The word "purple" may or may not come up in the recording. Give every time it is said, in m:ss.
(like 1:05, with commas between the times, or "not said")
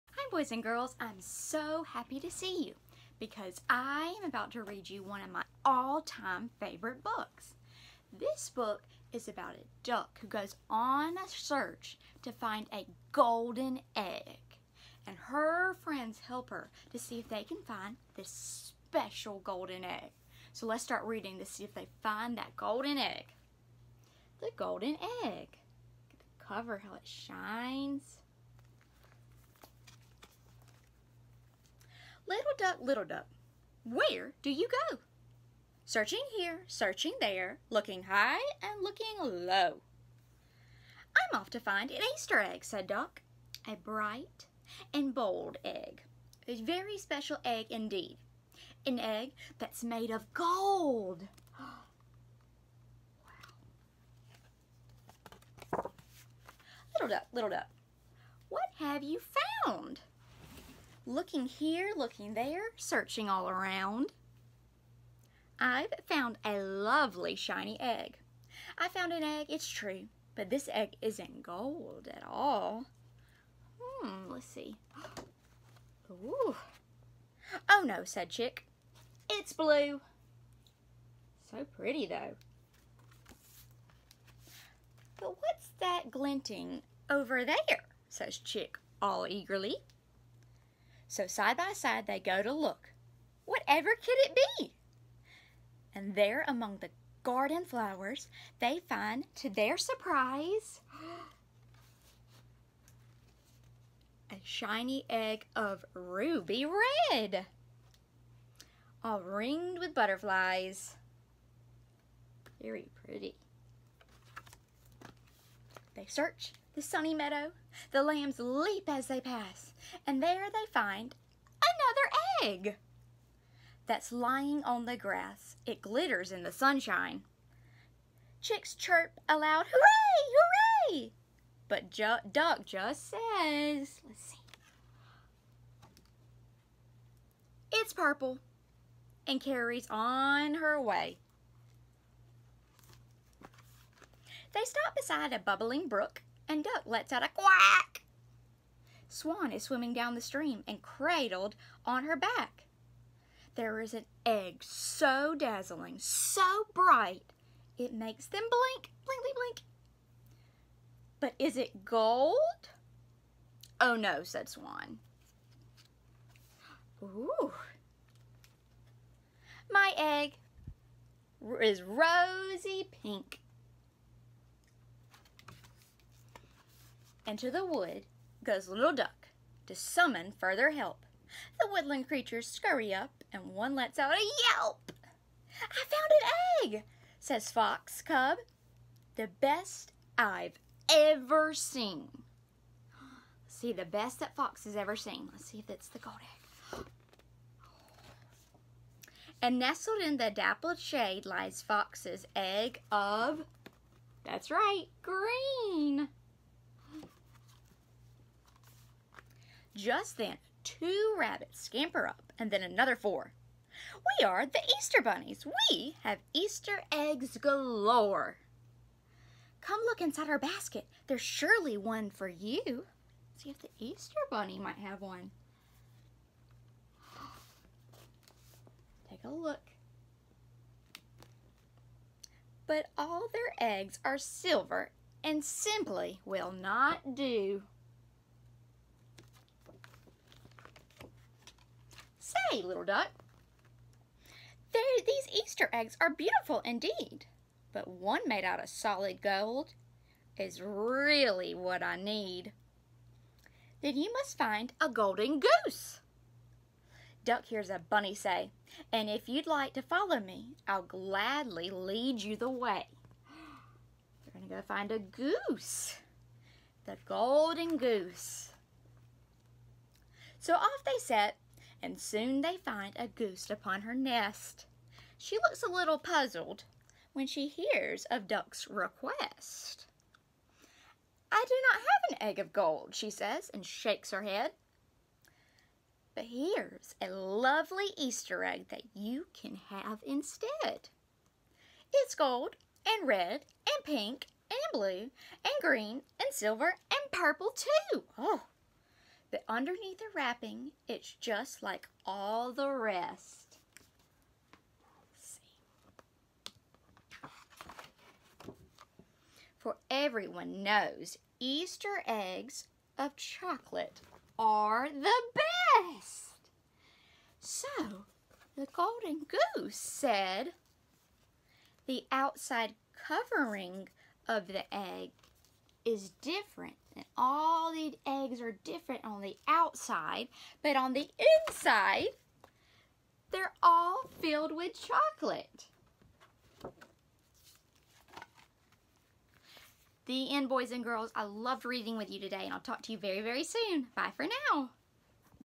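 2:17, 4:57.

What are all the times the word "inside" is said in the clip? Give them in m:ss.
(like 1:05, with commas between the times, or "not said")
3:39, 5:31.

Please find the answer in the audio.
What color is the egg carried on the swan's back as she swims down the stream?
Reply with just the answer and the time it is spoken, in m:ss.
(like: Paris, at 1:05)
Rosy pink, at 2:51.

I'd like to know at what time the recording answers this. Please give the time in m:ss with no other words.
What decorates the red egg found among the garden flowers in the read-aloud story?
1:49.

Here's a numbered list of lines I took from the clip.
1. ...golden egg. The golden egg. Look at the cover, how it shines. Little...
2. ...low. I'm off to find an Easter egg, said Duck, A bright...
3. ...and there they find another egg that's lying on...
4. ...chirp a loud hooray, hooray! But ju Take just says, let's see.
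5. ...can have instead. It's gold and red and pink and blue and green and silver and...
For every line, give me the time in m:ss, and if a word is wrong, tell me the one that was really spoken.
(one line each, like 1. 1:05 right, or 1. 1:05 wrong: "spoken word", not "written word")
1. 0:22 right
2. 0:39 right
3. 2:00 right
4. 2:08 wrong: "Duck", not "Take"
5. 4:49 right.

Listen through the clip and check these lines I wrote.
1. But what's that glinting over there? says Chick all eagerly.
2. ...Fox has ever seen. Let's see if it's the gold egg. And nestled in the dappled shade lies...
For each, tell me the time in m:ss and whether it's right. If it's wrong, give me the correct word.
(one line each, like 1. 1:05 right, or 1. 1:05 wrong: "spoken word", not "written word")
1. 1:25 right
2. 3:14 right.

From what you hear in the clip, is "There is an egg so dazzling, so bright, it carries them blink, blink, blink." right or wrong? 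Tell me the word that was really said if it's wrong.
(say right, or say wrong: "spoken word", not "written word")
wrong: "makes", not "carries".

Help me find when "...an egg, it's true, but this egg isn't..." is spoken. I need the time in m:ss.
1:09.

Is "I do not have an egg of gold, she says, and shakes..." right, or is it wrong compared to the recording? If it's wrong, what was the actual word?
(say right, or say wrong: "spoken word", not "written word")
right.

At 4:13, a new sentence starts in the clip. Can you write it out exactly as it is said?
Then you must find a golden goose.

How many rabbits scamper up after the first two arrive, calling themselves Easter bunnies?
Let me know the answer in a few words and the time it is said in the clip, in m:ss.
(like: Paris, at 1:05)
4, at 3:32.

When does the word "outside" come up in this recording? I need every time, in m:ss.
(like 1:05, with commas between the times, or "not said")
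5:22, 5:29.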